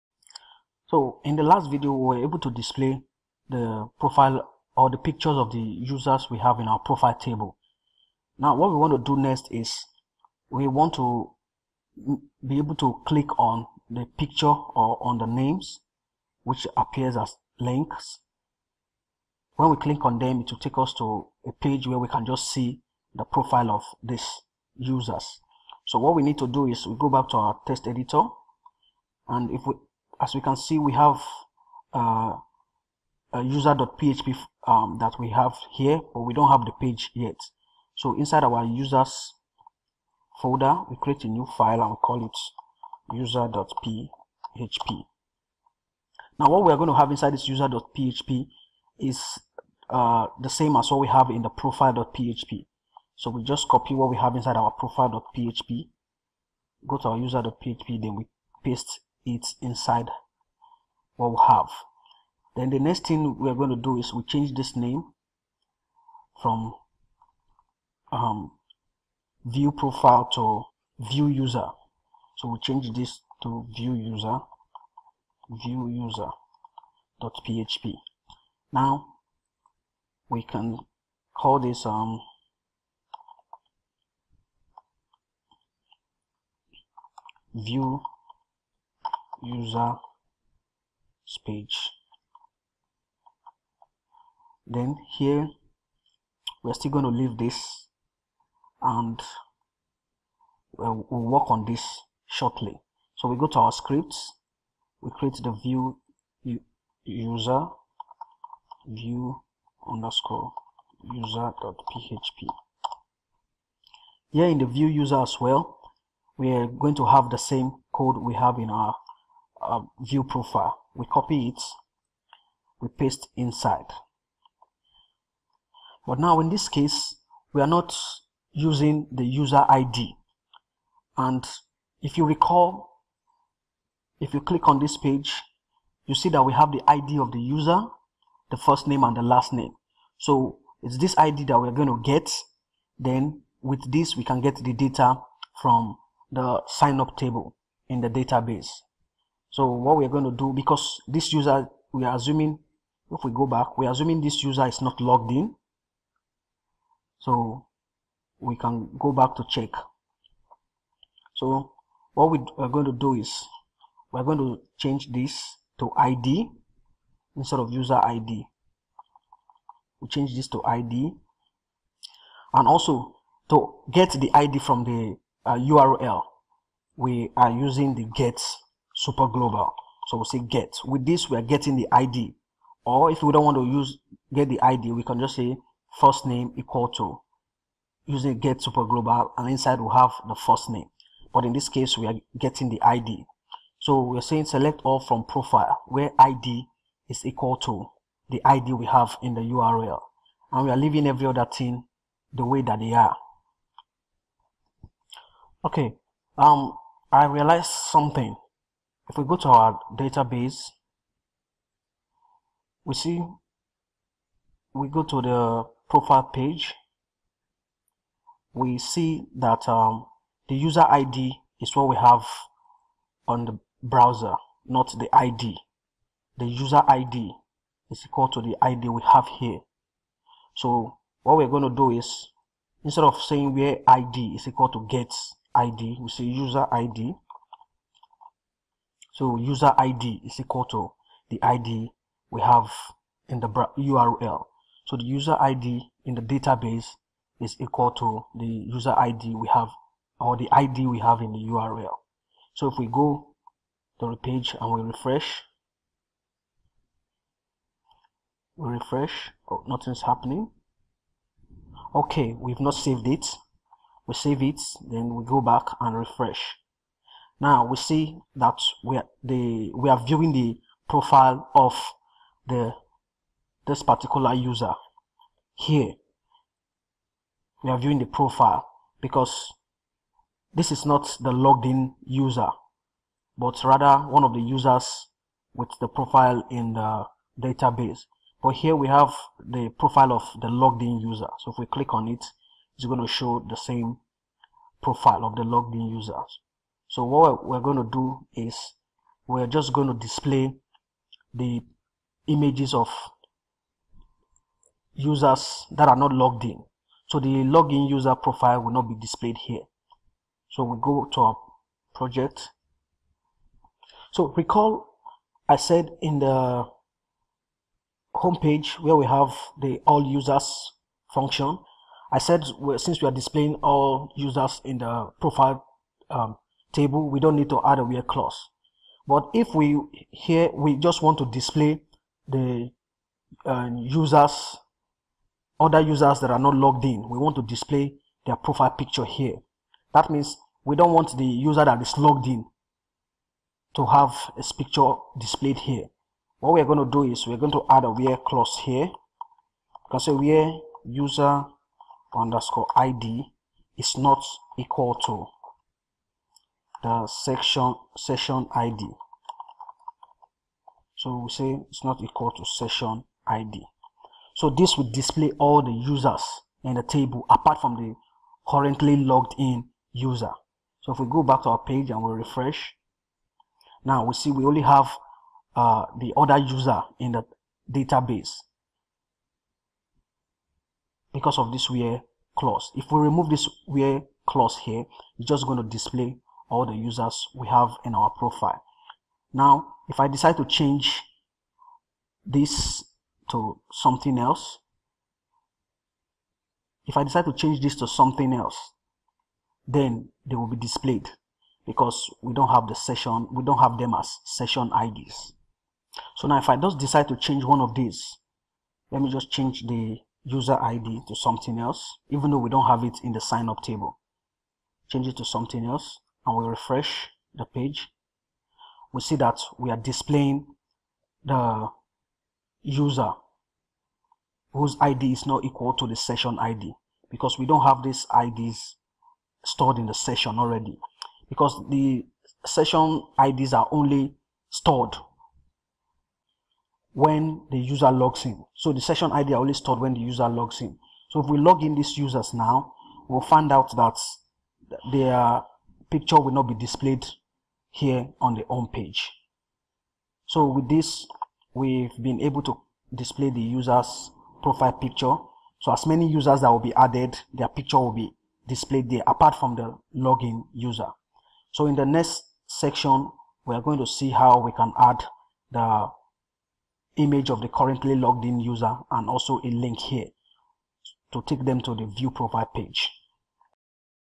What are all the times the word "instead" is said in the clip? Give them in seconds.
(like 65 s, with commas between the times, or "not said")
167 s, 232 s.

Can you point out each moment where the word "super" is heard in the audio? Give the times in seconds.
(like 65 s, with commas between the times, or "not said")
178 s, 188 s.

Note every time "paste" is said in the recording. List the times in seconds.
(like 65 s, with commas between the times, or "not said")
58 s, 122 s.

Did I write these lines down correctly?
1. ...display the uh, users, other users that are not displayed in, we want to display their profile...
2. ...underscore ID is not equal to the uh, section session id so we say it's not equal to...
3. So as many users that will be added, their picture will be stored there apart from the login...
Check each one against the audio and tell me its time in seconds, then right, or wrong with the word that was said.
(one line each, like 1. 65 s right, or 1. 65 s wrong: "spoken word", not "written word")
1. 331 s wrong: "logged", not "displayed"
2. 352 s right
3. 455 s wrong: "displayed", not "stored".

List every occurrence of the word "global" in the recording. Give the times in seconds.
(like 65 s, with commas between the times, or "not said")
179 s, 188 s.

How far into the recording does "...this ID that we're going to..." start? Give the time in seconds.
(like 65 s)
140 s.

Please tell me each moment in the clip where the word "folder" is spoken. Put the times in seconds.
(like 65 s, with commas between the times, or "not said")
40 s.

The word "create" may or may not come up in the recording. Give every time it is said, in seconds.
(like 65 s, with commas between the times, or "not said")
41 s, 105 s.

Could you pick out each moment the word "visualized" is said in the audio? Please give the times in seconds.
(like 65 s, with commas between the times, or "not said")
not said.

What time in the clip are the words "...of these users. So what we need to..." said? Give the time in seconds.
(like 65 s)
23 s.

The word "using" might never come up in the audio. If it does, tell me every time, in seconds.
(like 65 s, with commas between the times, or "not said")
128 s, 177 s, 188 s.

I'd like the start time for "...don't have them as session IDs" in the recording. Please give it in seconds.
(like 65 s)
403 s.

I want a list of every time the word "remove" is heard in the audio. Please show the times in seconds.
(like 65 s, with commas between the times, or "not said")
383 s.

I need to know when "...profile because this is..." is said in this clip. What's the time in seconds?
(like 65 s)
278 s.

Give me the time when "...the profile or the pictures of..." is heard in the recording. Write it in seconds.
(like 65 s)
3 s.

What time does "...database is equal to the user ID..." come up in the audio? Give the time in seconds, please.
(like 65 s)
246 s.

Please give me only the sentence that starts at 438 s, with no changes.
So the session ID are only stored when the user logs in.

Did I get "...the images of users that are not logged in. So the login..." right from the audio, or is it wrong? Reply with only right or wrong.
right.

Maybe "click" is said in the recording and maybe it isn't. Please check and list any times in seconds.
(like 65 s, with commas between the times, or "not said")
13 s, 19 s, 134 s, 291 s.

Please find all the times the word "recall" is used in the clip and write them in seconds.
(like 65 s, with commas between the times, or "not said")
132 s, 314 s.